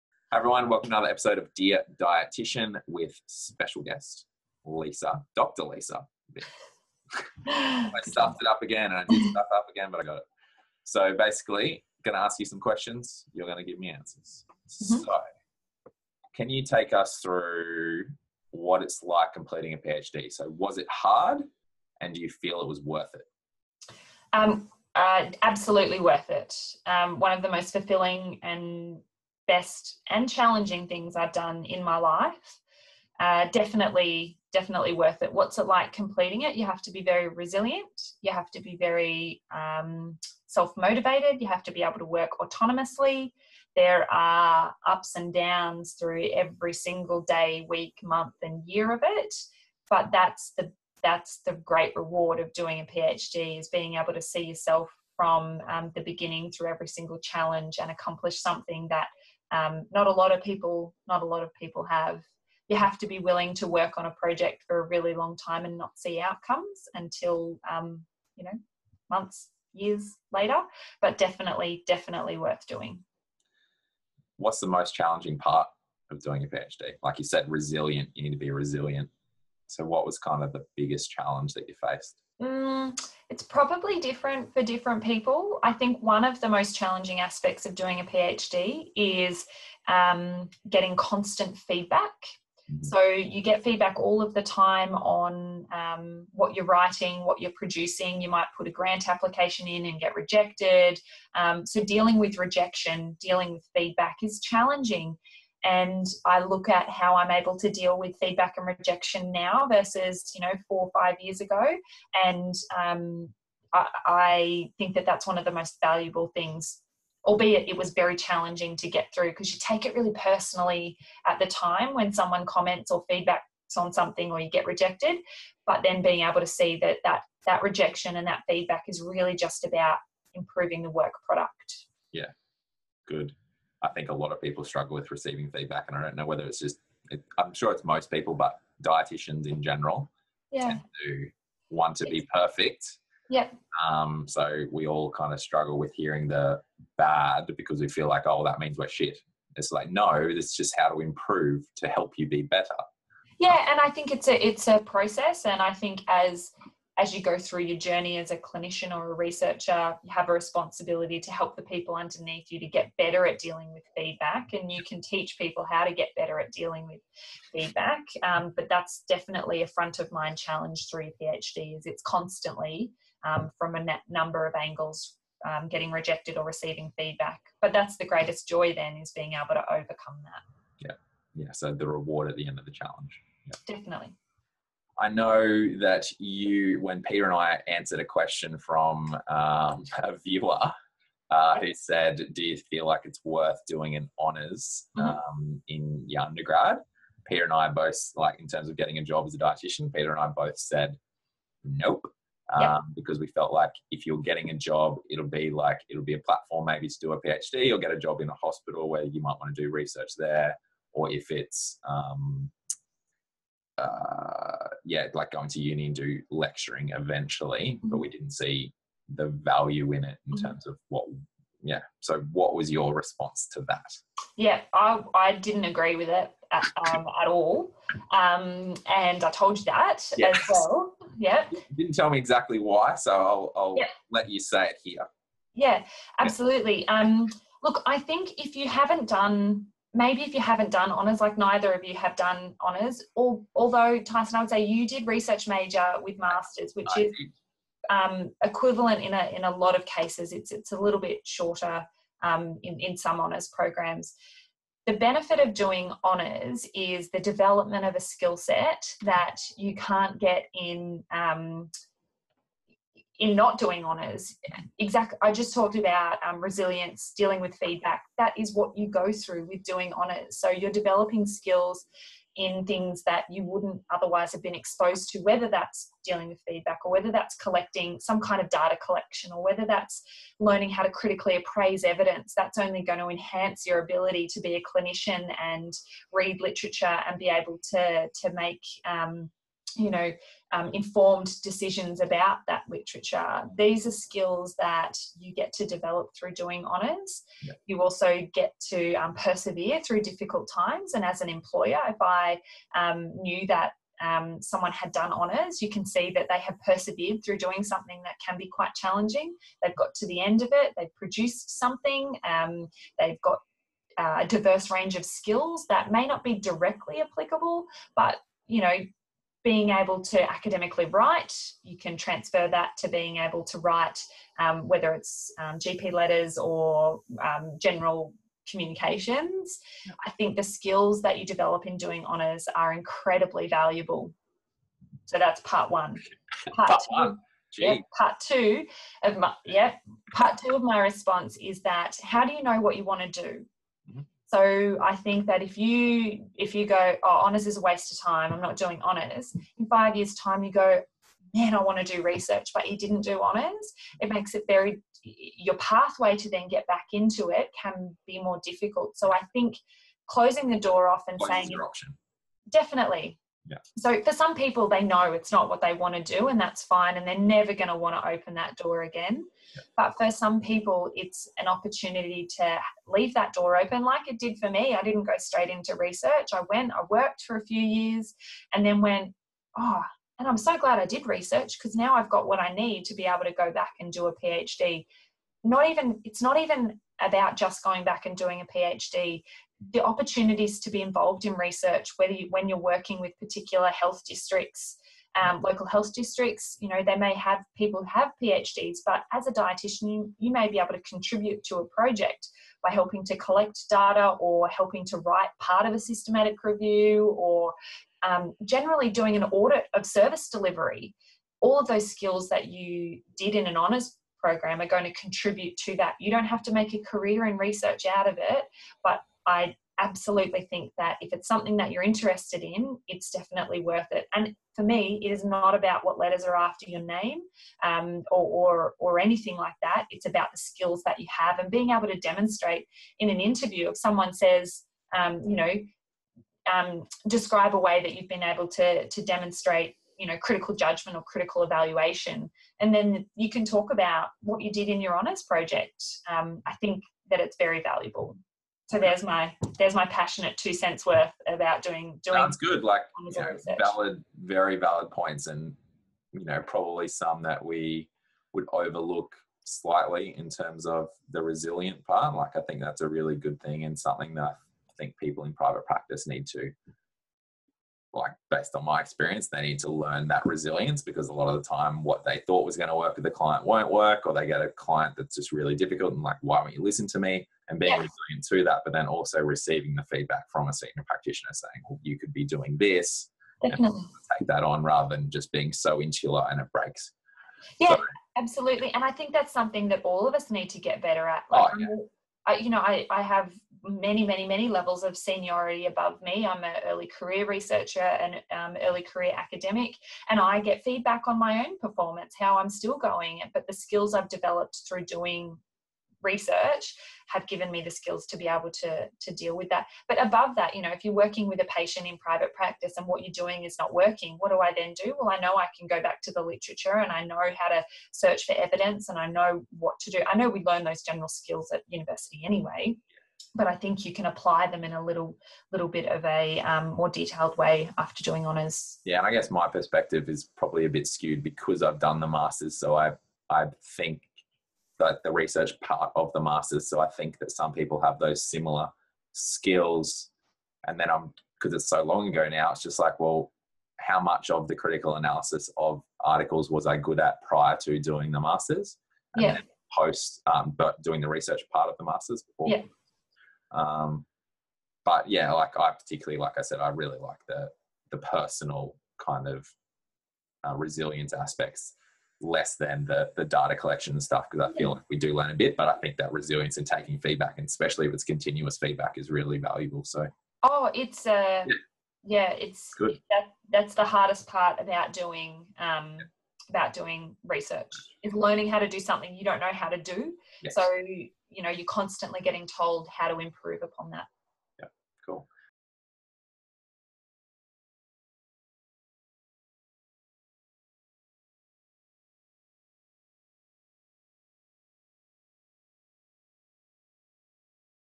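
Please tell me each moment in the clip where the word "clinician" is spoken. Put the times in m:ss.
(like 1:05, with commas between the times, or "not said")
2:38, 4:44.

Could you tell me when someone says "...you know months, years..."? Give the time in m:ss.
1:08.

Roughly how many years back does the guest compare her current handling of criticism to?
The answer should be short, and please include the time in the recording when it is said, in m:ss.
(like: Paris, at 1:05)
4 or 5 years, at 1:50.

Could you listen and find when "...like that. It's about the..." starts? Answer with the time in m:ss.
7:09.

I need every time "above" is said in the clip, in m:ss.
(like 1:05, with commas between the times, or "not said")
8:15, 8:30.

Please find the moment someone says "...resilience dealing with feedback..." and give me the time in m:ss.
4:26.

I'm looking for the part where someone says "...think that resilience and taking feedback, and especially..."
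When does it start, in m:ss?
9:25.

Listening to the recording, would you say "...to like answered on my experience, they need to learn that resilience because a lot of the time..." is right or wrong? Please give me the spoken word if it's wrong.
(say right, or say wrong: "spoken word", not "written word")
wrong: "based", not "answered".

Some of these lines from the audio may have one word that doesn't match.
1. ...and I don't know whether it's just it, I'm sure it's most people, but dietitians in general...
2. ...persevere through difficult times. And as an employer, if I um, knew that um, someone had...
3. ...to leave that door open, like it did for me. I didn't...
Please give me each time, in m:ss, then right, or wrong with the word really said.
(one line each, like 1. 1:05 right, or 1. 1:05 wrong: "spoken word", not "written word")
1. 2:15 right
2. 4:59 right
3. 6:12 right.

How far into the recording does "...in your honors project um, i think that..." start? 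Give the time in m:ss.
7:24.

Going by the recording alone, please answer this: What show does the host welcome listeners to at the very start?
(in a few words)
Dear Dietitian.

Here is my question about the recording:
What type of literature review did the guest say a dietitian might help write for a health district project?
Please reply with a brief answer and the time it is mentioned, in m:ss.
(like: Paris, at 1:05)
Systematic review, at 6:45.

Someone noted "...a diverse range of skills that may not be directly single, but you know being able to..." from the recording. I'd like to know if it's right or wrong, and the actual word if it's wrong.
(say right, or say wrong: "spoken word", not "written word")
wrong: "applicable", not "single".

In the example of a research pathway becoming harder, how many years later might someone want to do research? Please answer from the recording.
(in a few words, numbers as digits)
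5 years.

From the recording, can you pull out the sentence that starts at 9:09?
Post, um, but doing the research part of the masters before.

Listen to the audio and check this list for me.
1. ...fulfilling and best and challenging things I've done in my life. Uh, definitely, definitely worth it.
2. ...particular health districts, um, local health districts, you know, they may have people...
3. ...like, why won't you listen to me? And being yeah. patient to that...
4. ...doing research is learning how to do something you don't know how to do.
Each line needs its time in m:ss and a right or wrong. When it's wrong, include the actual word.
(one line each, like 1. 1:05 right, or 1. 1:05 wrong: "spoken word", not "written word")
1. 0:27 right
2. 6:33 right
3. 7:56 wrong: "resilient", not "patient"
4. 9:36 right.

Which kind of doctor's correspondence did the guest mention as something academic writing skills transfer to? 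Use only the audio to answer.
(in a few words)
GP letters.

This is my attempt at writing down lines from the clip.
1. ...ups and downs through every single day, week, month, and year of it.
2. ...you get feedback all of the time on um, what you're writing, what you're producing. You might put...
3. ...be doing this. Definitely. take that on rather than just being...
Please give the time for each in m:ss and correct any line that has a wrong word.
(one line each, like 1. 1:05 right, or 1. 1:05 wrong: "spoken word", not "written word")
1. 0:44 right
2. 1:33 right
3. 8:02 right.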